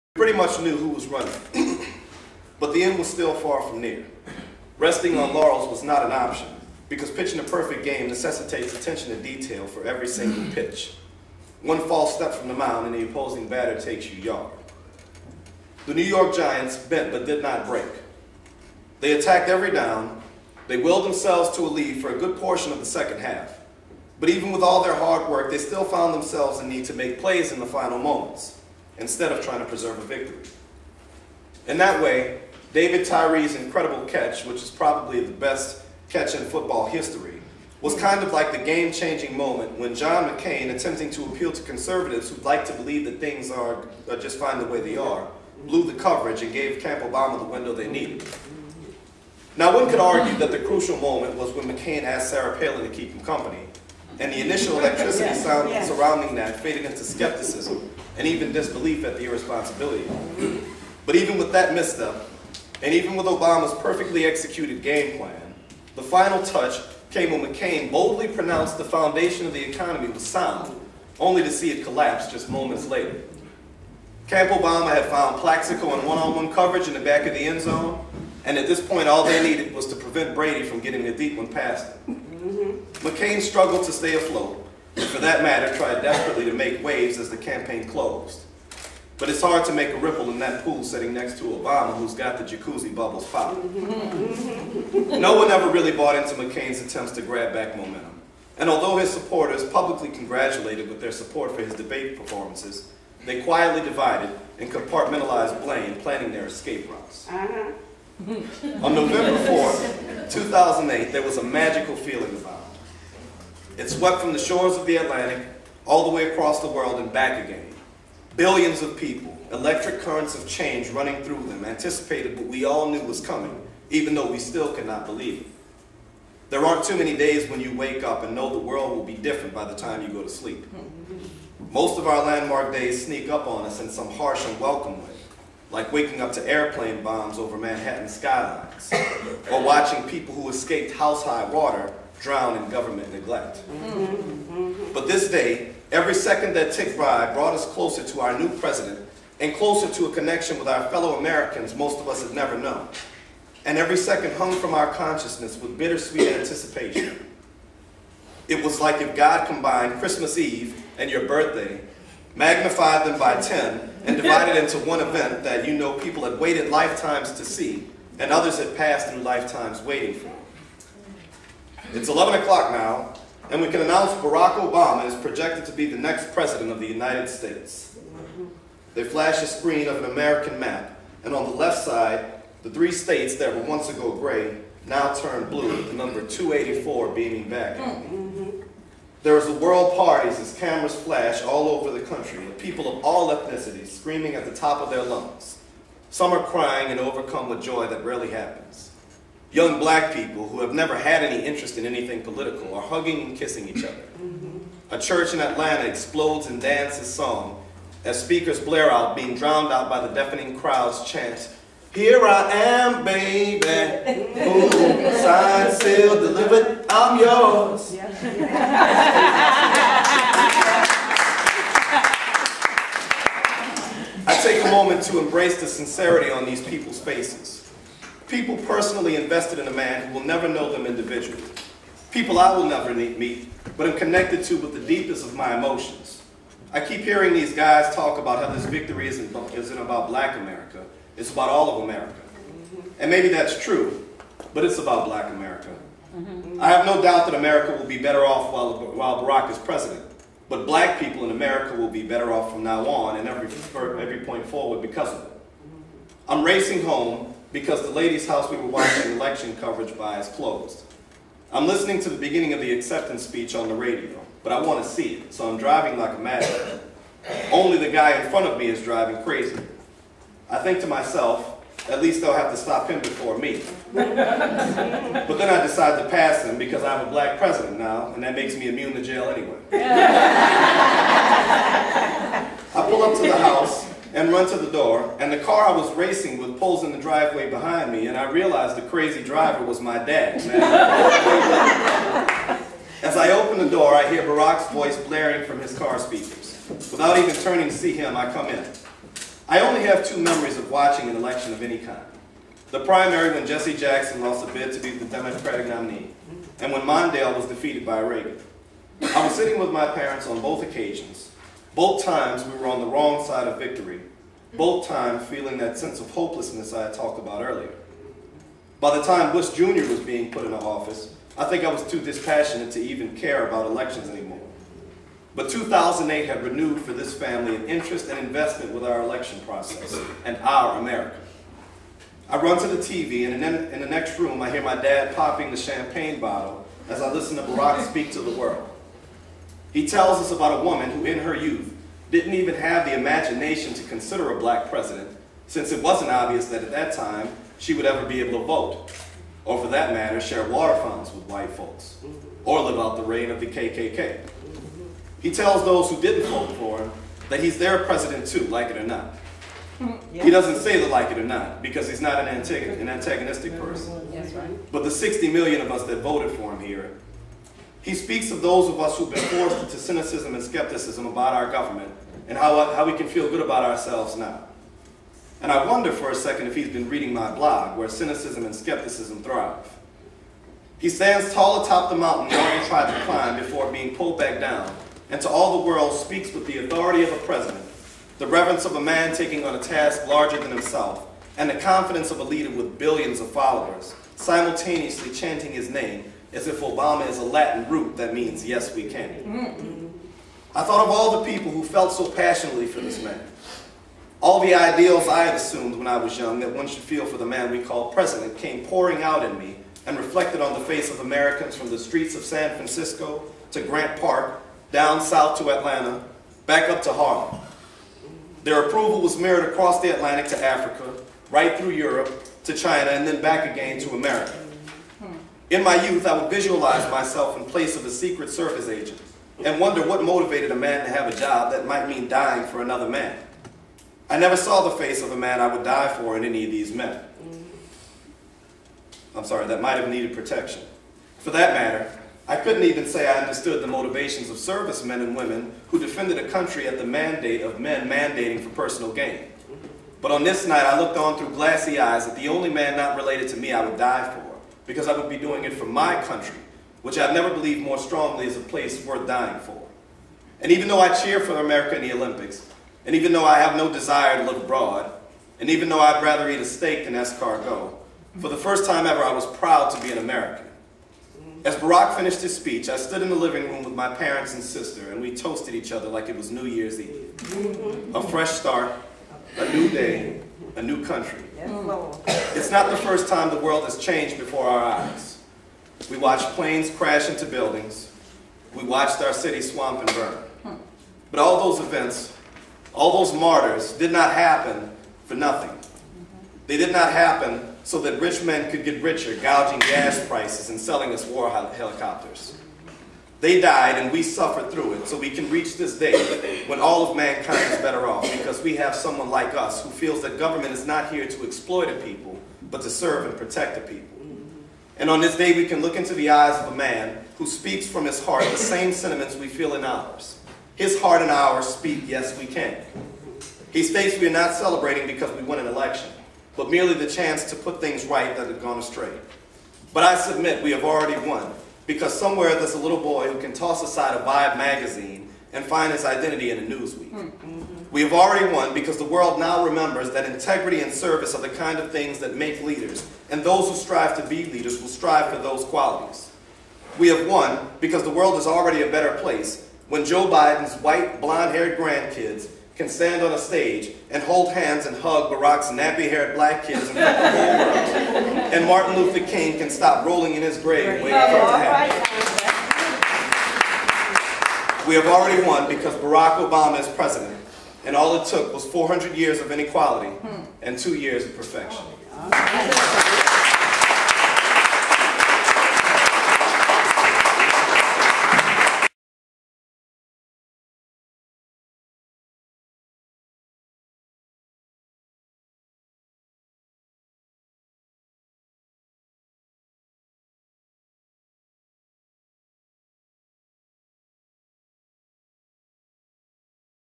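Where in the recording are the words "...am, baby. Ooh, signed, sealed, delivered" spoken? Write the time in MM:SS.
03:32.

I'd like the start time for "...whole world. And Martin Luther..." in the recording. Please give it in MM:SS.
09:16.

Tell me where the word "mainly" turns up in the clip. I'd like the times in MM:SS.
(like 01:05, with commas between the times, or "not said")
not said.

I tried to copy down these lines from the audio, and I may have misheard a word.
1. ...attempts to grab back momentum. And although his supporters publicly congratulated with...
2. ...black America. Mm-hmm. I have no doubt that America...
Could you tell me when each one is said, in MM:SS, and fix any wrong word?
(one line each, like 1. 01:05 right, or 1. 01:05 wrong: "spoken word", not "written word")
1. 01:36 right
2. 04:05 right.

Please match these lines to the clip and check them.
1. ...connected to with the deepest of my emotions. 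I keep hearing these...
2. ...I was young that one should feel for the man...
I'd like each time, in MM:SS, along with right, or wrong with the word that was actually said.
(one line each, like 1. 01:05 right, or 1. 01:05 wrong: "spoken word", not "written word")
1. 03:53 right
2. 06:45 right.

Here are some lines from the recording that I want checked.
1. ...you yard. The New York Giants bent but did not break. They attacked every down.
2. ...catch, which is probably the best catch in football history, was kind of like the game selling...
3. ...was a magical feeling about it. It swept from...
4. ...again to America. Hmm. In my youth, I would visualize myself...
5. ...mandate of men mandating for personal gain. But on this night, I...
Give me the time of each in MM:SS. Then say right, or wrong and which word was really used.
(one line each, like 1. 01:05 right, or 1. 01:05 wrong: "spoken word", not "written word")
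1. 00:14 right
2. 00:34 wrong: "changing", not "selling"
3. 01:51 right
4. 07:03 right
5. 07:26 right.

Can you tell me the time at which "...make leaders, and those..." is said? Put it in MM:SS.
09:02.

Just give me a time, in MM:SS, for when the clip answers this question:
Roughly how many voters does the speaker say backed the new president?
06:04.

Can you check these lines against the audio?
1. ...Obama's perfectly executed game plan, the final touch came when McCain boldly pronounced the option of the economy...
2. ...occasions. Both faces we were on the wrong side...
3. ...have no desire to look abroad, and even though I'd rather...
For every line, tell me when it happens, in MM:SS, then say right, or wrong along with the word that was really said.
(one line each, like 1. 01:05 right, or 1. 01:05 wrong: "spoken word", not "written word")
1. 01:03 wrong: "foundation", not "option"
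2. 05:10 wrong: "times", not "faces"
3. 07:43 right.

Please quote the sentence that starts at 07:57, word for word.
A fresh start, a new day, a new country.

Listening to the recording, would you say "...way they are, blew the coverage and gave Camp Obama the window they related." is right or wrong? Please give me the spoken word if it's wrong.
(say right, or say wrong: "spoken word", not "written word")
wrong: "needed", not "related".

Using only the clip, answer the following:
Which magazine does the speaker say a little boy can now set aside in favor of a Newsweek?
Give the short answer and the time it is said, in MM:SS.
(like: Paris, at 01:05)
Vibe, at 08:54.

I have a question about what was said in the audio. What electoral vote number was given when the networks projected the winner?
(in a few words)
284.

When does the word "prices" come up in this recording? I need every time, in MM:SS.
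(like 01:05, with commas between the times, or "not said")
08:20.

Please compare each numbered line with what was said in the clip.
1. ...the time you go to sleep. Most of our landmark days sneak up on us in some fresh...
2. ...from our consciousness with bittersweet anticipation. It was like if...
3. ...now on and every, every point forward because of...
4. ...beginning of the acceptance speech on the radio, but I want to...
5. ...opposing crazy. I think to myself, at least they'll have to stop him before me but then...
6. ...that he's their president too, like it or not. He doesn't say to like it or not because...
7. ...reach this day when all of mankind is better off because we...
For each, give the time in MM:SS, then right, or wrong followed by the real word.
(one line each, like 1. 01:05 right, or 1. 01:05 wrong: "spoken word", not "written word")
1. 02:09 wrong: "harsh", not "fresh"
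2. 02:34 right
3. 04:12 right
4. 04:22 right
5. 04:28 wrong: "driving", not "opposing"
6. 05:57 right
7. 08:25 right.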